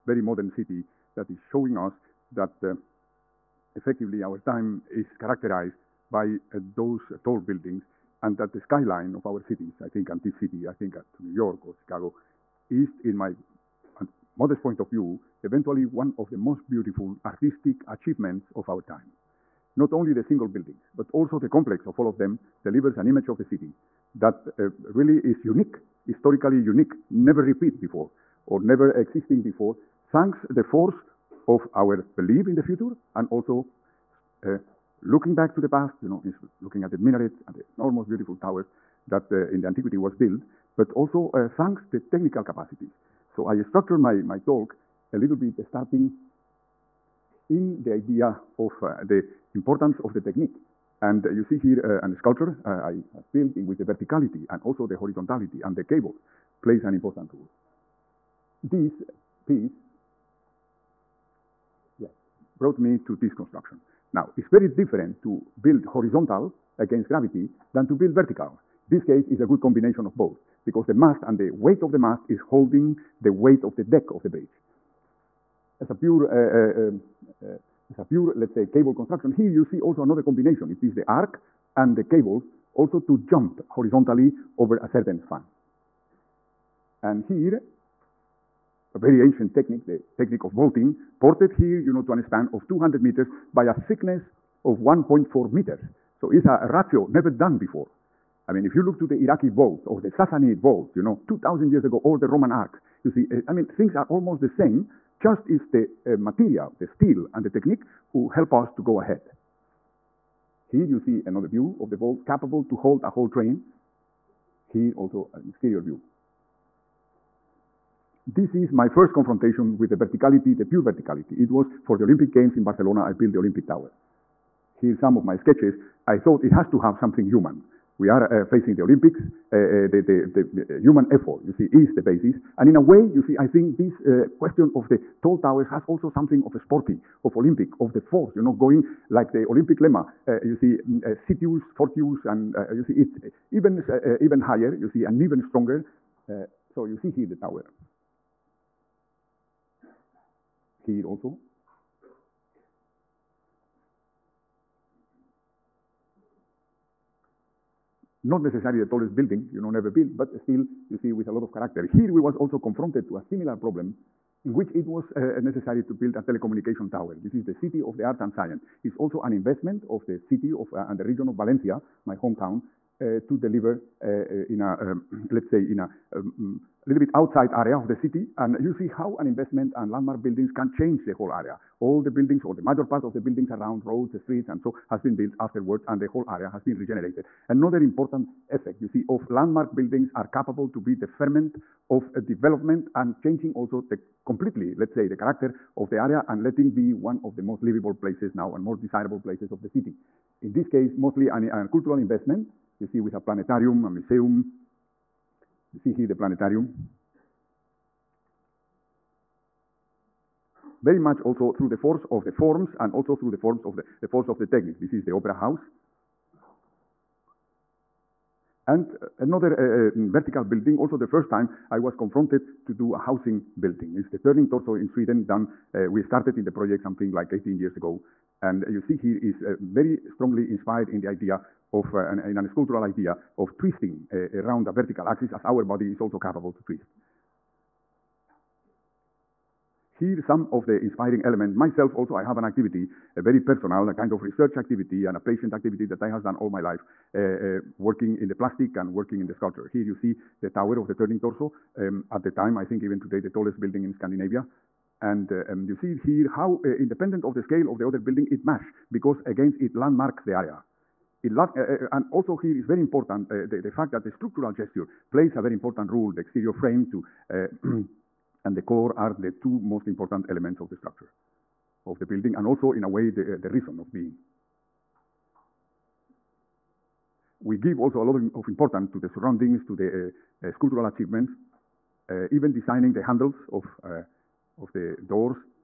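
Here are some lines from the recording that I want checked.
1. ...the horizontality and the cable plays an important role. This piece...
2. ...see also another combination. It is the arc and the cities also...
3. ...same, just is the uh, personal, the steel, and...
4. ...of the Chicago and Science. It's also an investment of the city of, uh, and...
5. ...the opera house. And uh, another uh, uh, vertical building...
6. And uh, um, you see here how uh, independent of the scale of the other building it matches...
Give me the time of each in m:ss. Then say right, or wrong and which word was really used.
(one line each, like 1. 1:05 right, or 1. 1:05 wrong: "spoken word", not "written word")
1. 0:54 right
2. 1:19 wrong: "cables", not "cities"
3. 1:44 wrong: "material", not "personal"
4. 2:47 wrong: "Arts", not "Chicago"
5. 3:35 right
6. 4:15 right.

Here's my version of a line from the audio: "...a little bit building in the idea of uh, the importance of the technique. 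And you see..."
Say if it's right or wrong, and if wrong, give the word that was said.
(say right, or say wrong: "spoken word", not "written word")
wrong: "starting", not "building".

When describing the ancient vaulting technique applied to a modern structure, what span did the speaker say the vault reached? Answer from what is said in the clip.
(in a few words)
200 meters.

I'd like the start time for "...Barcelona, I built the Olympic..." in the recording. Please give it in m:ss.
2:02.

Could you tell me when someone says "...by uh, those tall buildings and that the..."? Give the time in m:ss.
0:06.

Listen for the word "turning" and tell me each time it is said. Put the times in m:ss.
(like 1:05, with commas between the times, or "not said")
3:44, 4:10.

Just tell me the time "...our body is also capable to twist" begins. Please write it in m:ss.
3:55.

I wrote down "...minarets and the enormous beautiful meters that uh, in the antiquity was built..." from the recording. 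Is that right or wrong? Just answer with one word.
wrong.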